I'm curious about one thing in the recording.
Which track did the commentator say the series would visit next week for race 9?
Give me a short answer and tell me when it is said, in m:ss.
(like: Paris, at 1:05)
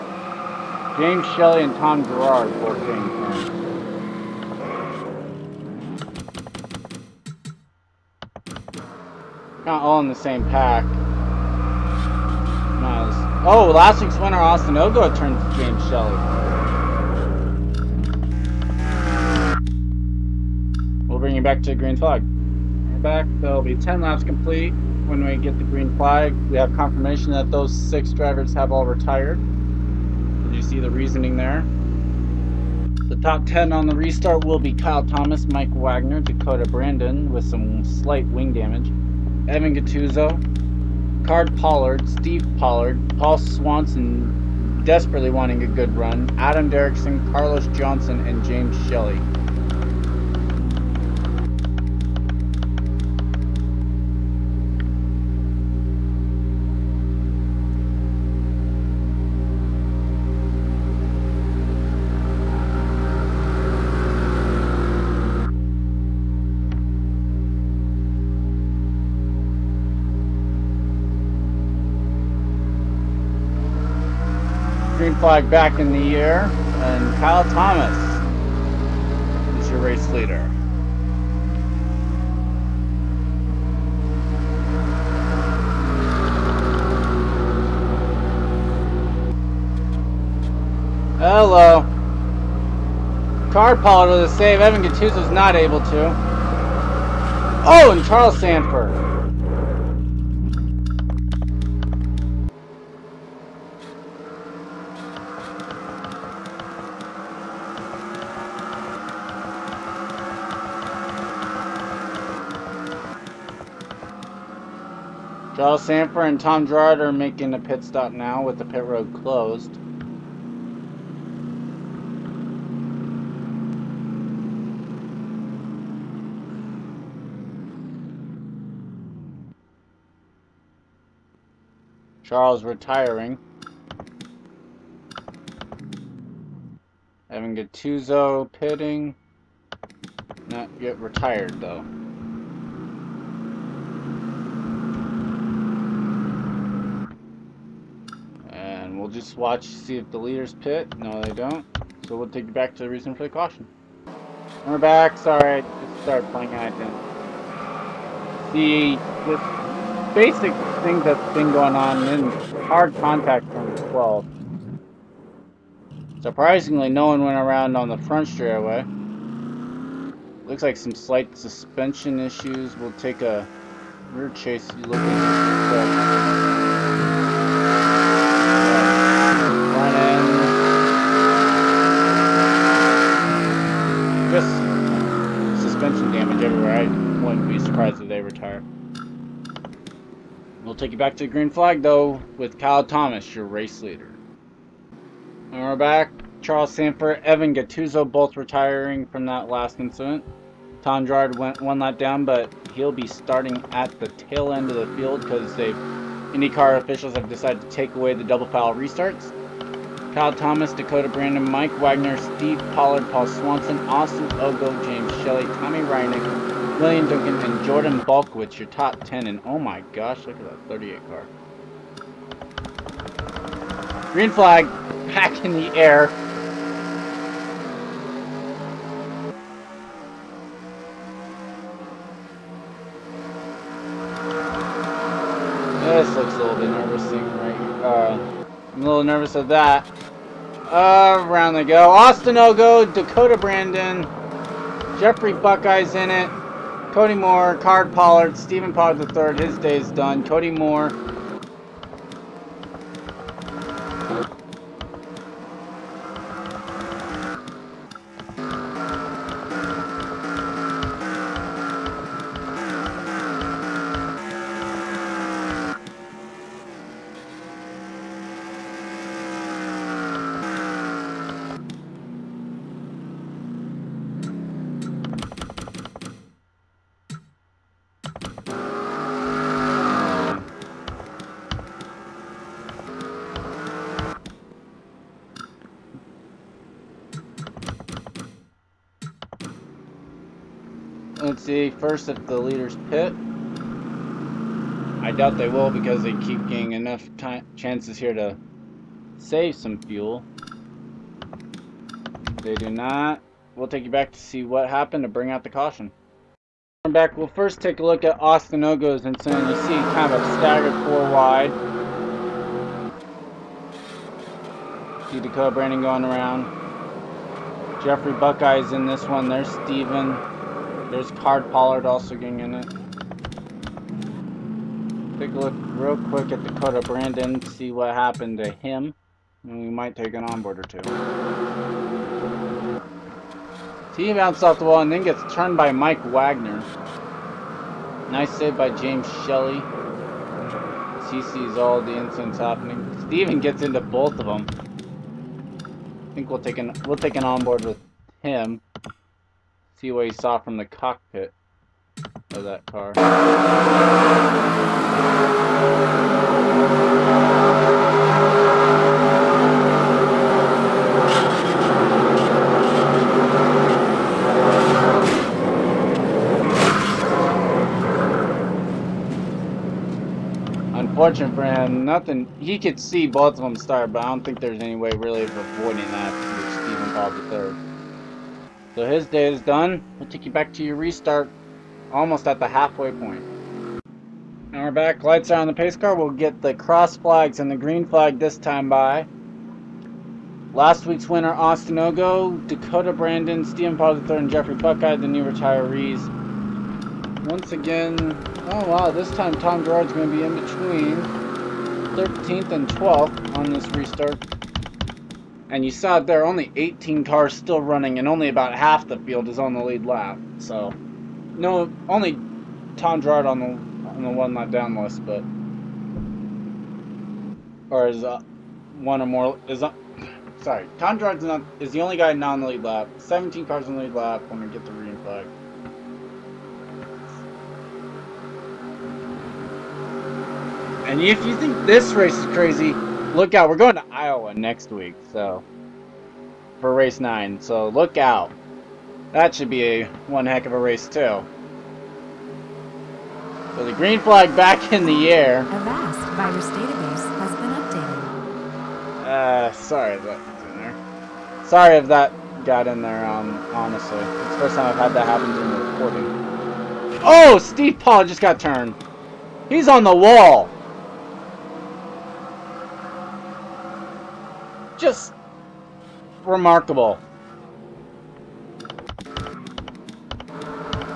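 Iowa, at 7:13.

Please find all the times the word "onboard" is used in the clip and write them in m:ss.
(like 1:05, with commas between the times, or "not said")
5:30, 5:47.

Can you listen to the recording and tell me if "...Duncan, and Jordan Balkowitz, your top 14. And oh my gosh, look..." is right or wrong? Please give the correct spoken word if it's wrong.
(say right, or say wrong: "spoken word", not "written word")
wrong: "10", not "14".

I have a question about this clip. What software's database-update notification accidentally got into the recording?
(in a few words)
Avast.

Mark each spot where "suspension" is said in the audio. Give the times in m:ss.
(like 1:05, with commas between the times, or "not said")
2:51.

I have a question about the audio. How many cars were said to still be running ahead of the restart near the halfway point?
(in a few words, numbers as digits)
18.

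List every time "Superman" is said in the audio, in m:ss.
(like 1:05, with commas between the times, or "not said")
not said.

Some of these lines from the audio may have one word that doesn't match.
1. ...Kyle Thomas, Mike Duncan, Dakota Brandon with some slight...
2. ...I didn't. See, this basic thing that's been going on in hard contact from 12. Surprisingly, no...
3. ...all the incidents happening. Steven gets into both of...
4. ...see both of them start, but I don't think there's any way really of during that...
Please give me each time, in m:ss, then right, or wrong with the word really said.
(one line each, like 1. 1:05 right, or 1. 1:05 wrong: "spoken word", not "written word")
1. 0:34 wrong: "Wagner", not "Duncan"
2. 2:36 right
3. 5:41 right
4. 6:12 wrong: "avoiding", not "during".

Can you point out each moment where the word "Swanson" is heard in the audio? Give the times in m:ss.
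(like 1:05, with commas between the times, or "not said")
0:43, 3:33.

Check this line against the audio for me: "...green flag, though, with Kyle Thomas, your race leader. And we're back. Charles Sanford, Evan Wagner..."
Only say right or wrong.
wrong.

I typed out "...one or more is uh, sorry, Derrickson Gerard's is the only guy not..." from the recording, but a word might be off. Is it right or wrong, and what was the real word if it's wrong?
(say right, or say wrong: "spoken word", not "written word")
wrong: "Tom", not "Derrickson".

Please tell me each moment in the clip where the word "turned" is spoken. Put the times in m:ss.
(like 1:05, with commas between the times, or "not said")
0:15, 5:35, 7:38.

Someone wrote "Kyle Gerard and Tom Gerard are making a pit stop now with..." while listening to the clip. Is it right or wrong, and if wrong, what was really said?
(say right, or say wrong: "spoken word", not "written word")
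wrong: "Sanford", not "Gerard".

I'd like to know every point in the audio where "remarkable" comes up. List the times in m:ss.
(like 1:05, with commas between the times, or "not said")
7:46.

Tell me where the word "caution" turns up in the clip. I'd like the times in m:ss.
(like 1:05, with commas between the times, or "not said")
2:33, 5:05.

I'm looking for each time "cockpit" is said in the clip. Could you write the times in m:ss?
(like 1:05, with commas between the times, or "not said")
5:50.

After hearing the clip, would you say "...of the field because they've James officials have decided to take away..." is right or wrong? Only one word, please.
wrong.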